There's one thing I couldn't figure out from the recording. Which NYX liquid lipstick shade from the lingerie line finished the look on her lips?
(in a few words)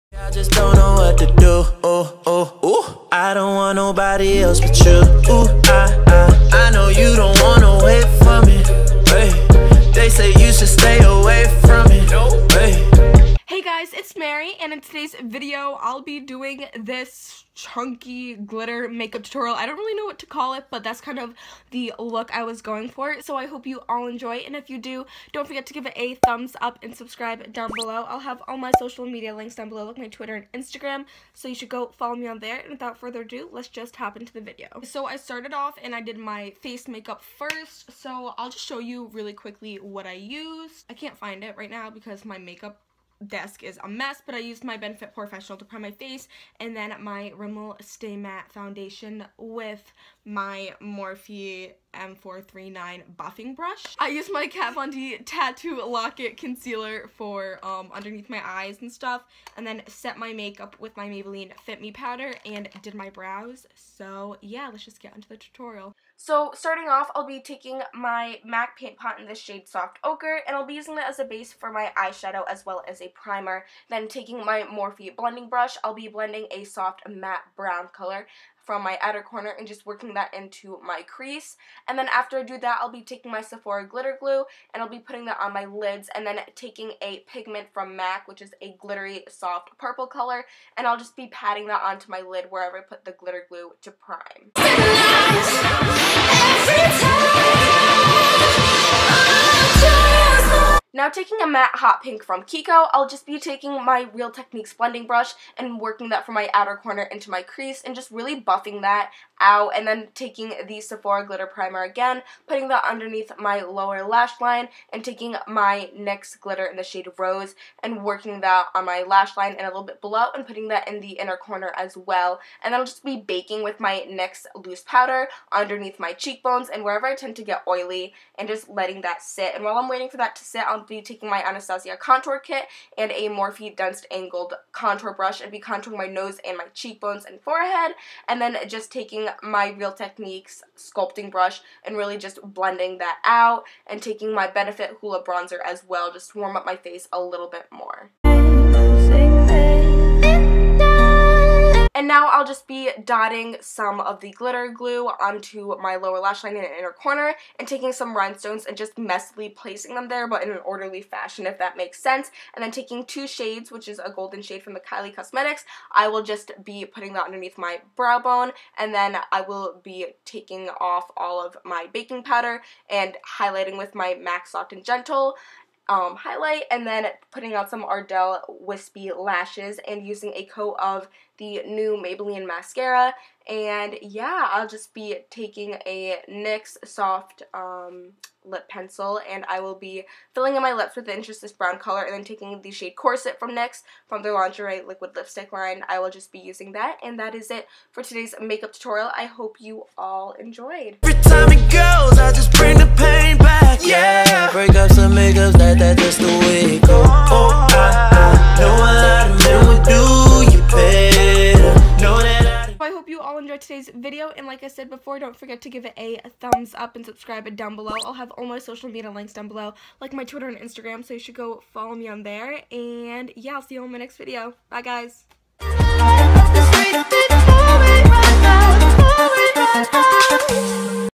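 Corset.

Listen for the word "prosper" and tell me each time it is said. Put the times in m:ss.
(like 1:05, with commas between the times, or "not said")
not said.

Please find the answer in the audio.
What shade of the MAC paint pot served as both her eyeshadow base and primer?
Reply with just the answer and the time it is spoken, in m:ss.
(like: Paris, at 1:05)
Soft Ochre, at 1:09.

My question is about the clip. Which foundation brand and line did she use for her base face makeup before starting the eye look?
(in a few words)
Rimmel Stay Matte.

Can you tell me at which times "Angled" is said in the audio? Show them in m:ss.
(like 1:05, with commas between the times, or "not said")
2:14.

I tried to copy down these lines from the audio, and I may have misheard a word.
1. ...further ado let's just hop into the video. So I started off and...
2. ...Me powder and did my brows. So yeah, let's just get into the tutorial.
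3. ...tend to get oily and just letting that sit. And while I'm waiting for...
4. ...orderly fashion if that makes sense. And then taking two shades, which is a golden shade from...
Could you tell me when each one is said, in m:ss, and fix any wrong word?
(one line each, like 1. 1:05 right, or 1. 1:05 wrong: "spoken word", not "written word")
1. 0:32 right
2. 1:01 right
3. 2:07 right
4. 2:40 right.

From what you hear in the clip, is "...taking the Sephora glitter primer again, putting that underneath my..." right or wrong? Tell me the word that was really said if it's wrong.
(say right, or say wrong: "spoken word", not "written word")
right.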